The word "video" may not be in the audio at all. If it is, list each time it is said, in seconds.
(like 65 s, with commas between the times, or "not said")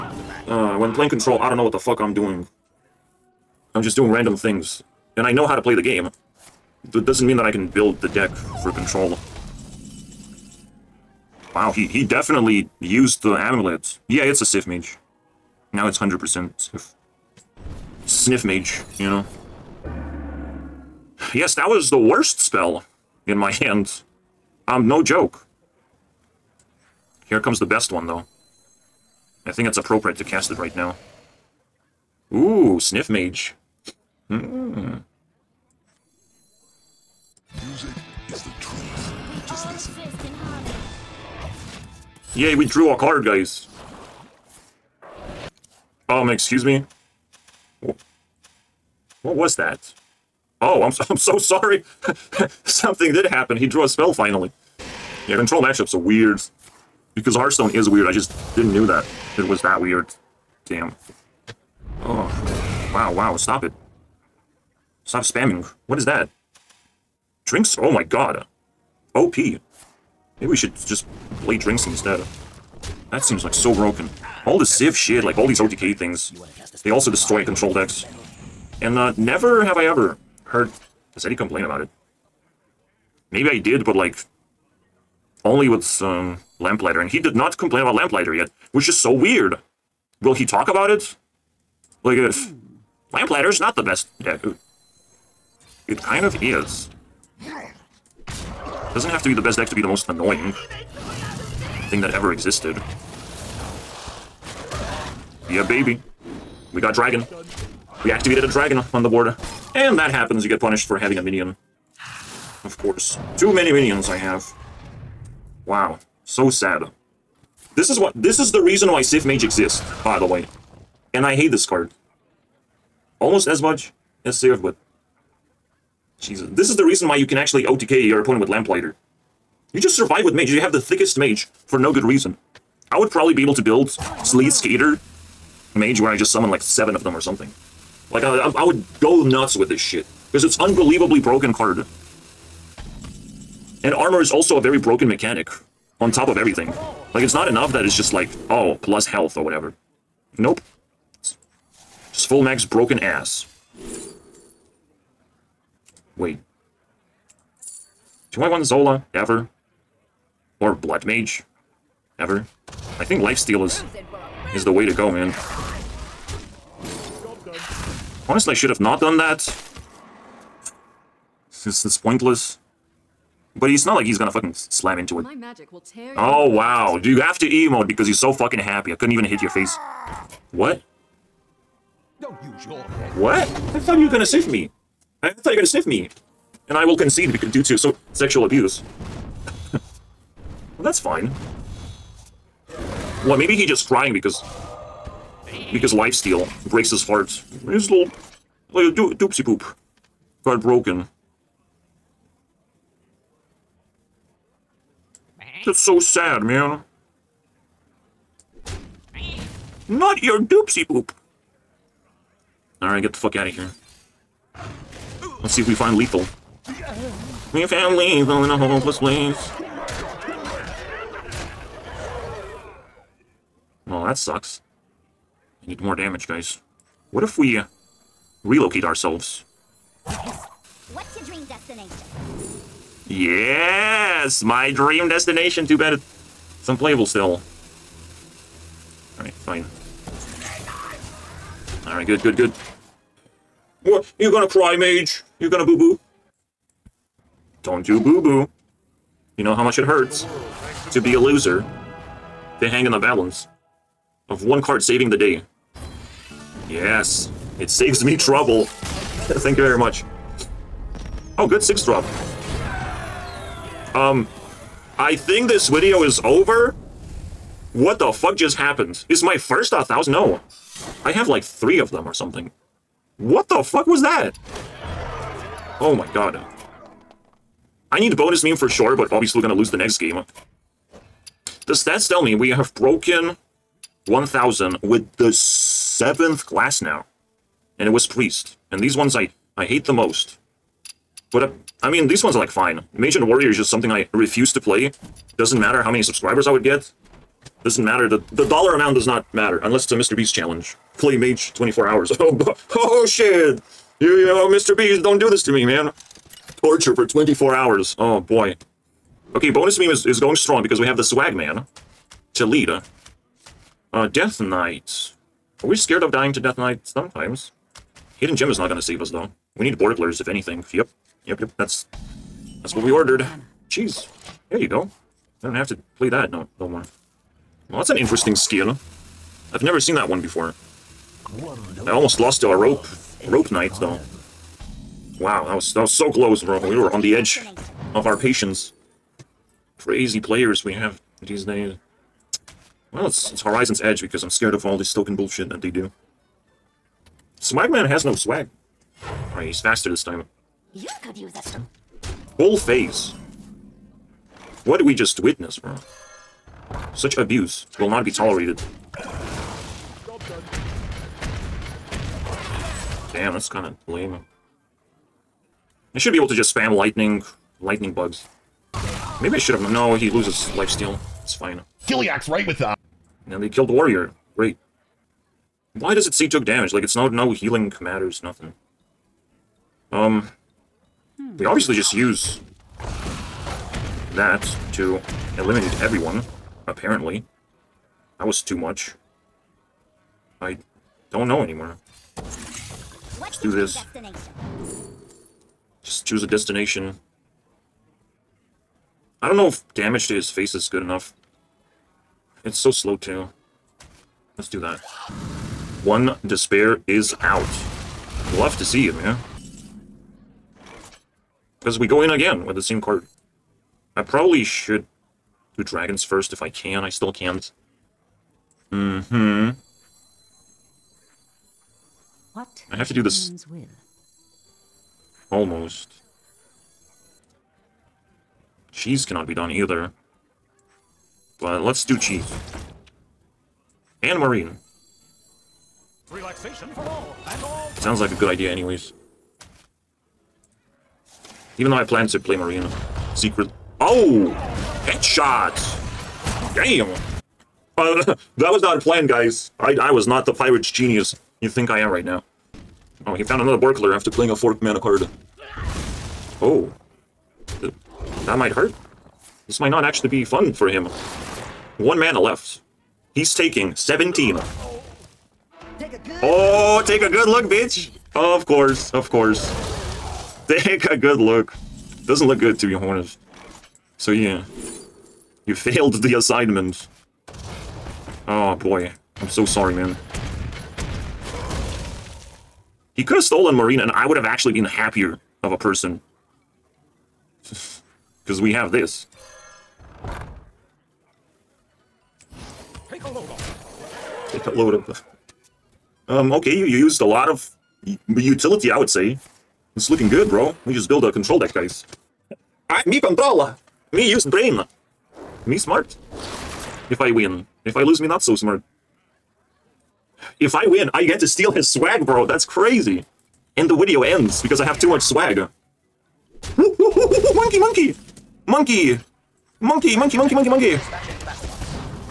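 265 s, 513 s.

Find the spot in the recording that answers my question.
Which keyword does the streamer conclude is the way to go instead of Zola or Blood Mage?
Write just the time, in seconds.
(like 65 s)
163 s.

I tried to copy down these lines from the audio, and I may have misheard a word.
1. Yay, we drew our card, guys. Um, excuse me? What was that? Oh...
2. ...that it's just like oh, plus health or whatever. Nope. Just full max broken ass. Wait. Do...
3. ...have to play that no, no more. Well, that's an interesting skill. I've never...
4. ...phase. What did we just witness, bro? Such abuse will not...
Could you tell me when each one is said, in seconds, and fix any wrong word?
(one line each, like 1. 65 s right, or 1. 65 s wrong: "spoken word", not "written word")
1. 42 s right
2. 147 s right
3. 325 s right
4. 352 s right.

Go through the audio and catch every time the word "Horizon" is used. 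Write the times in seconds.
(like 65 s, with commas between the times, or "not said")
343 s.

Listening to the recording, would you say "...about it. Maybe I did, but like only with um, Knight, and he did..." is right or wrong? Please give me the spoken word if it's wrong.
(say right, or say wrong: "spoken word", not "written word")
wrong: "Lamplighter", not "Knight".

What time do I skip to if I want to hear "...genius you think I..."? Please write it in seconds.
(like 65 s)
450 s.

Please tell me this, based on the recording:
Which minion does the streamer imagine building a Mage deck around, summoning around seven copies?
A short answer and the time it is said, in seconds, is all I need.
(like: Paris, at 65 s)
Sleet Skater, at 134 s.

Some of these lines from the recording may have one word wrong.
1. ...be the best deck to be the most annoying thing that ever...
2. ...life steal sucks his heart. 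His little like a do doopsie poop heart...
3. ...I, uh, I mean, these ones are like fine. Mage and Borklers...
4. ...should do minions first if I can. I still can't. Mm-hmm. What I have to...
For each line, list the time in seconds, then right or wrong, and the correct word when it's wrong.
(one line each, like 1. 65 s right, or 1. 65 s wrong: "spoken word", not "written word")
1. 99 s right
2. 195 s wrong: "breaks", not "sucks"
3. 291 s wrong: "Warrior", not "Borklers"
4. 414 s wrong: "dragons", not "minions".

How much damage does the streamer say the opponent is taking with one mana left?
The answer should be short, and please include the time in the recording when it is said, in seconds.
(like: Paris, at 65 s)
17, at 463 s.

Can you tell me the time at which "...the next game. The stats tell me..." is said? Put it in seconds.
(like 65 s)
279 s.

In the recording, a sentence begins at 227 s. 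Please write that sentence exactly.
What if we uh, relocate ourselves?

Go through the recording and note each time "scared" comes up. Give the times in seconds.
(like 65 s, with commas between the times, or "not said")
315 s, 344 s.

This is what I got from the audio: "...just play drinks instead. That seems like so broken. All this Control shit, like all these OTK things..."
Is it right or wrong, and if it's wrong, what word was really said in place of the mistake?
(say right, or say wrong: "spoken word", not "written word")
wrong: "Sif", not "Control".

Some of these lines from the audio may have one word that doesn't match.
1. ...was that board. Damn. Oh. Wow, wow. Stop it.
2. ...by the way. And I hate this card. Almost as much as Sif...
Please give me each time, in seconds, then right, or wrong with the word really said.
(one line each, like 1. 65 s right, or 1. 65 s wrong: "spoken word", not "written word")
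1. 59 s wrong: "weird", not "board"
2. 120 s right.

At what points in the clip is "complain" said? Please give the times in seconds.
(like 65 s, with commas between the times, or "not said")
81 s, 87 s.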